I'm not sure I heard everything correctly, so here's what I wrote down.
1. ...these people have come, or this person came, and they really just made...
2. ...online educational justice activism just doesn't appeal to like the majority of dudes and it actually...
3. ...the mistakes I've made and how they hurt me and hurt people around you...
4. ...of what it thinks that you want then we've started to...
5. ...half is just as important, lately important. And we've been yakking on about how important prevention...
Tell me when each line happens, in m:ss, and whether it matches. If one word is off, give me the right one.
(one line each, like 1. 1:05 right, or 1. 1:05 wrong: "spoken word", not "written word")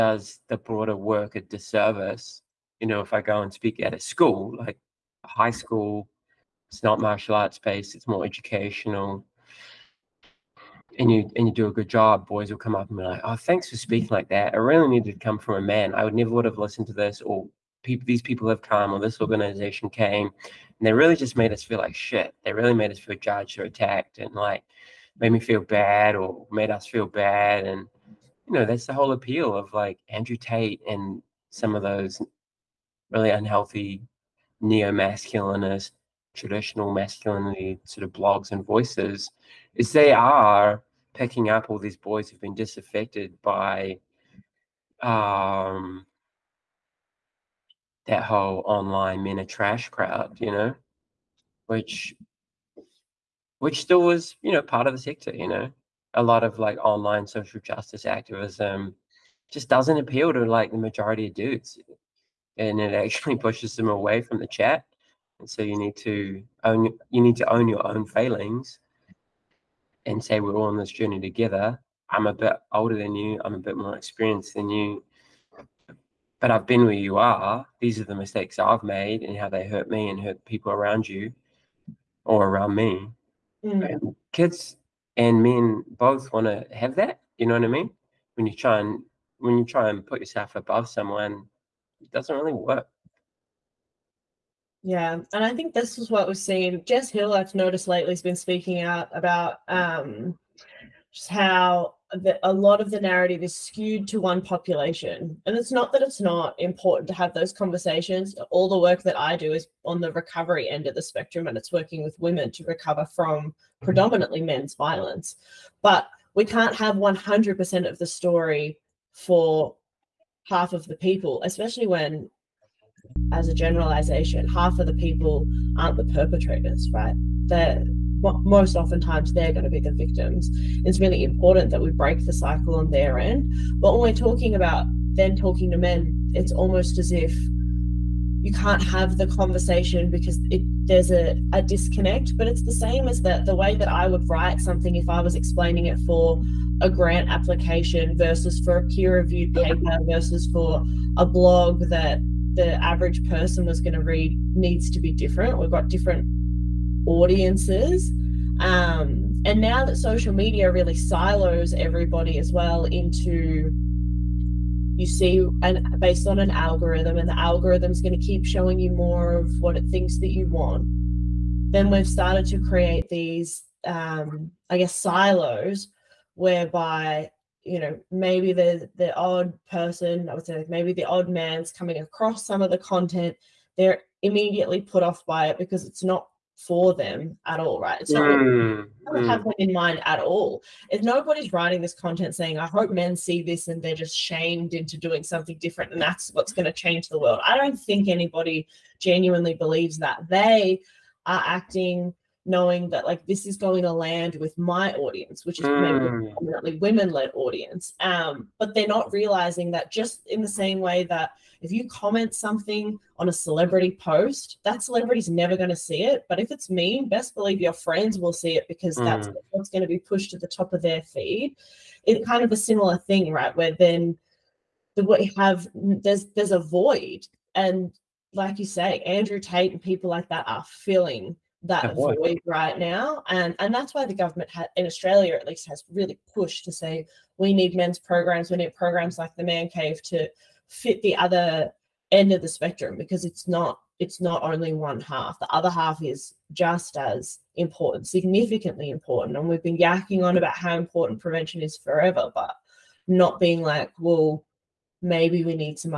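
1. 0:18 wrong: "organization", not "person"
2. 0:56 wrong: "social", not "educational"
3. 1:18 right
4. 2:49 right
5. 4:05 wrong: "significantly", not "lately".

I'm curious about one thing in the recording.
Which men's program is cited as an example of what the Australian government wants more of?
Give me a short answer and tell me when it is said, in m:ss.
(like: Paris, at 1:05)
The Man Cave, at 3:59.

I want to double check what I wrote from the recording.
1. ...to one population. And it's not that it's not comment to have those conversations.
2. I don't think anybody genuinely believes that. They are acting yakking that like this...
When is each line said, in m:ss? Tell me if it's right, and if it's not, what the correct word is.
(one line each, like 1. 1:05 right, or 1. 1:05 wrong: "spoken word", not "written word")
1. 1:44 wrong: "important", not "comment"
2. 3:17 wrong: "knowing", not "yakking".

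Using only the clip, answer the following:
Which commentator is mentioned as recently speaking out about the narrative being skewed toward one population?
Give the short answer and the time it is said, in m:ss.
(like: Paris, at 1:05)
Jess Hill, at 1:36.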